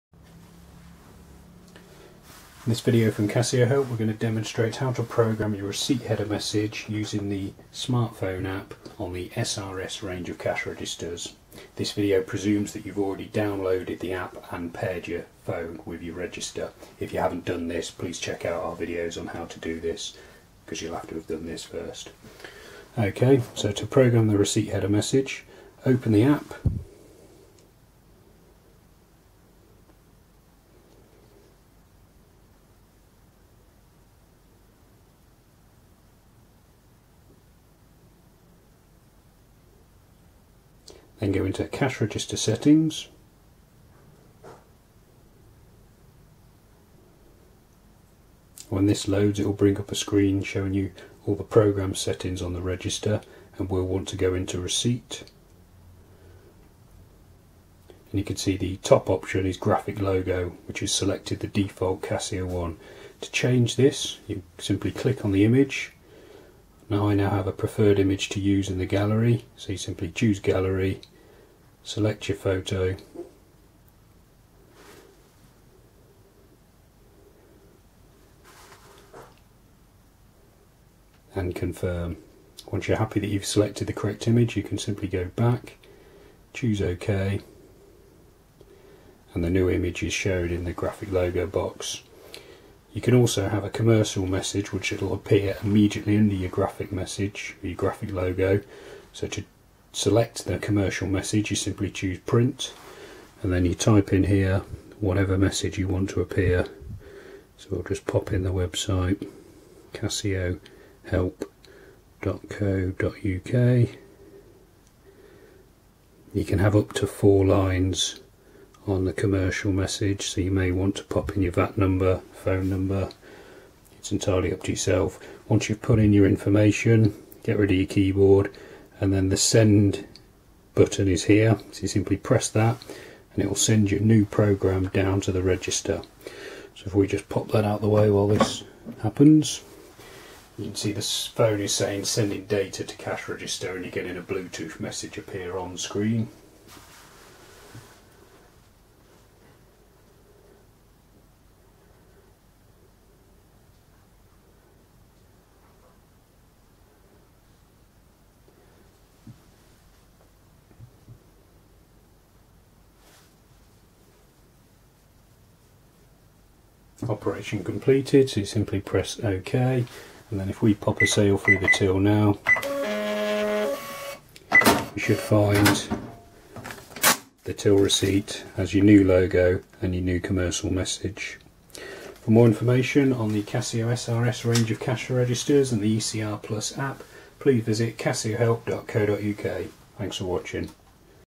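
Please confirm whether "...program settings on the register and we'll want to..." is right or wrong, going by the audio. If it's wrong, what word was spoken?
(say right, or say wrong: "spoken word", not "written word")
right.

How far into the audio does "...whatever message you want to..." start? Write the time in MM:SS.
01:44.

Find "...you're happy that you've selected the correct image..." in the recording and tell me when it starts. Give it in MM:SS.
01:22.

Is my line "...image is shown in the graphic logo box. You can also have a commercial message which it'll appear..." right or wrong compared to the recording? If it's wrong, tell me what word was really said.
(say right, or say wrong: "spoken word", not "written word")
right.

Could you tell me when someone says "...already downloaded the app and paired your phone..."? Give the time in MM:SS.
00:12.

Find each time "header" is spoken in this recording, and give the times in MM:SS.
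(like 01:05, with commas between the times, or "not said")
00:06, 00:24.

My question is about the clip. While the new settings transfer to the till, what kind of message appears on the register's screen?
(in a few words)
Bluetooth message.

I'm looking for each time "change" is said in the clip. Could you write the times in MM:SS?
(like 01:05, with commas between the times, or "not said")
01:03.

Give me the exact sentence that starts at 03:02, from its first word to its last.
For more information on the Casio SRS range of cash registers and the ECR Plus app please visit casiohelp.co.uk.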